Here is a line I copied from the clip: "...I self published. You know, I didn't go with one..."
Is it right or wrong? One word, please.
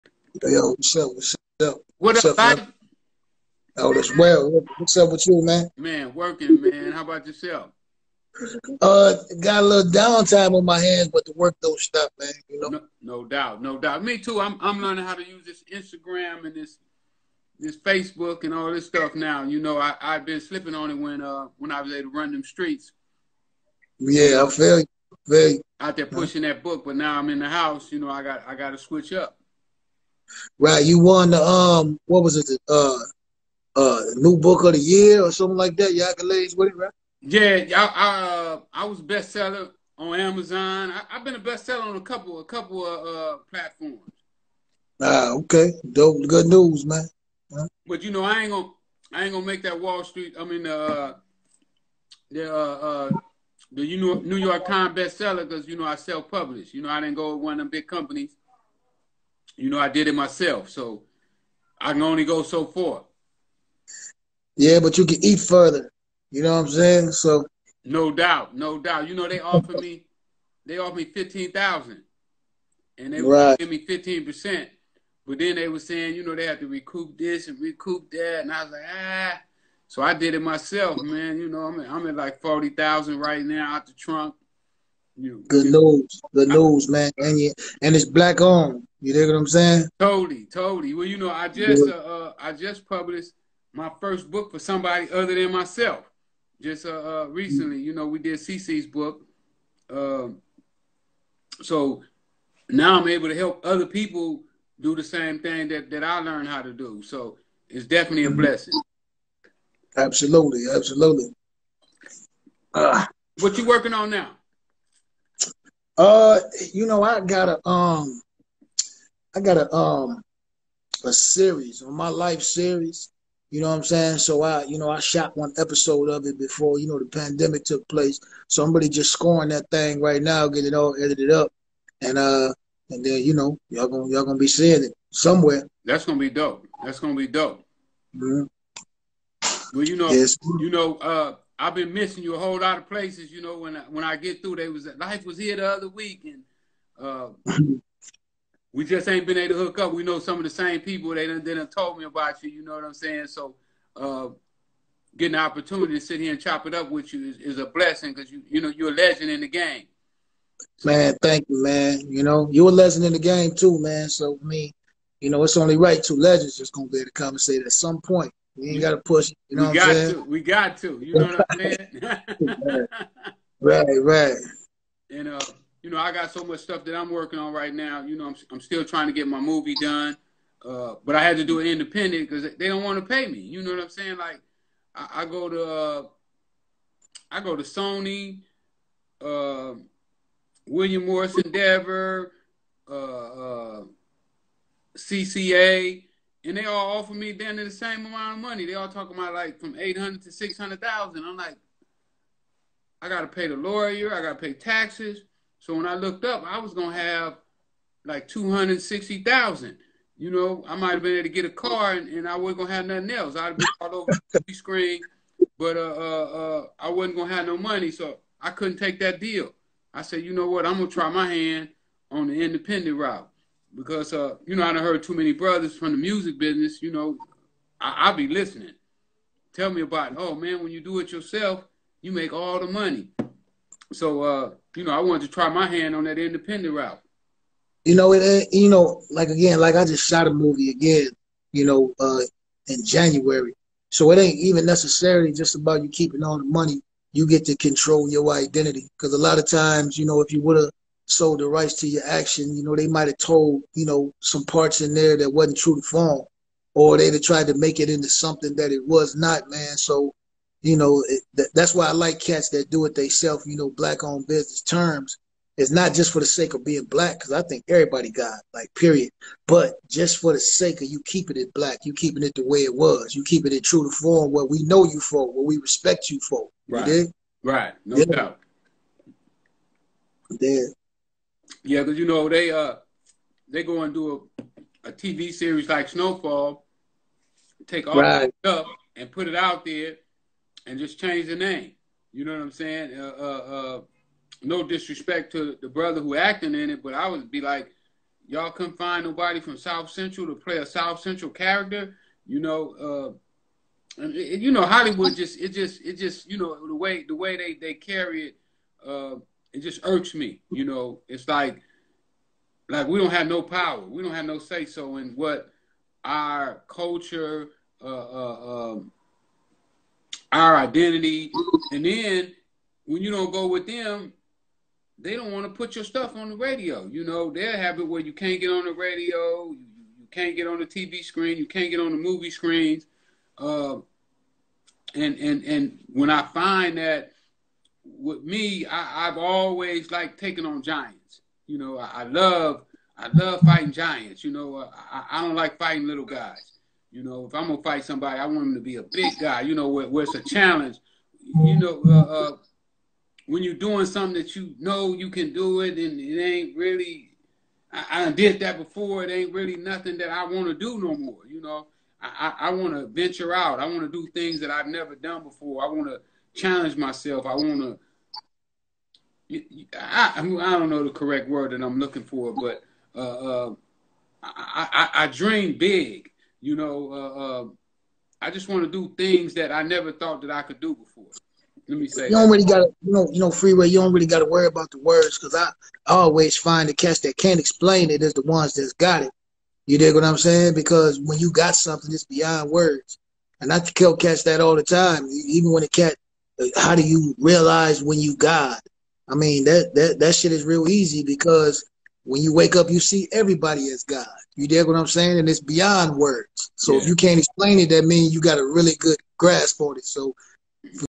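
right.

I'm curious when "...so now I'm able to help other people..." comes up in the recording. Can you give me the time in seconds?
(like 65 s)
101 s.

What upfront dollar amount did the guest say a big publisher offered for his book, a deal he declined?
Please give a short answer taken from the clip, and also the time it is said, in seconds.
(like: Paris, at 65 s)
$15,000, at 71 s.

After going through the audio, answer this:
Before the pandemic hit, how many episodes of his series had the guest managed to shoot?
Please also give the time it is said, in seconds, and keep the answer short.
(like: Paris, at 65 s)
1, at 125 s.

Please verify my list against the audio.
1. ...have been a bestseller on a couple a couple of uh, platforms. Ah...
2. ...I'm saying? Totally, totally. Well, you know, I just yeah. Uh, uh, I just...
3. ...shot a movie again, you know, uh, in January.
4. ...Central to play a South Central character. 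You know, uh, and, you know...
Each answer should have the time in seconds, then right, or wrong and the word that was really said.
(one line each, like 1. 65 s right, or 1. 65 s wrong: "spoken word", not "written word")
1. 41 s right
2. 89 s right
3. 240 s right
4. 299 s right.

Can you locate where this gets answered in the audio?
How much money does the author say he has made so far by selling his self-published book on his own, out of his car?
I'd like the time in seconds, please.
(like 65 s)
82 s.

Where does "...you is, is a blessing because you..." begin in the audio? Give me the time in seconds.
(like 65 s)
157 s.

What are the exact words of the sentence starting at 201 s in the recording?
I'm like, I gotta pay the lawyer, I gotta pay taxes.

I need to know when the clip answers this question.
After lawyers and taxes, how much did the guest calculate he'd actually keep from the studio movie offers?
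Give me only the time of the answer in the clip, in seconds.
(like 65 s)
208 s.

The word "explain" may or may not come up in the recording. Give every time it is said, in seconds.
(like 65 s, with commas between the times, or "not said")
387 s, 407 s.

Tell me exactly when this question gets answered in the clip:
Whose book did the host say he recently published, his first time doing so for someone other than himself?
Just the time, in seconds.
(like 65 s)
98 s.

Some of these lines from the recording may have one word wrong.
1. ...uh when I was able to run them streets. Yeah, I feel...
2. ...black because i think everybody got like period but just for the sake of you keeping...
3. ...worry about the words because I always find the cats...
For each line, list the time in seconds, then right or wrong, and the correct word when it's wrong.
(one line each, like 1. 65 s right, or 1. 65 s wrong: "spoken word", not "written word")
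1. 21 s right
2. 266 s right
3. 384 s right.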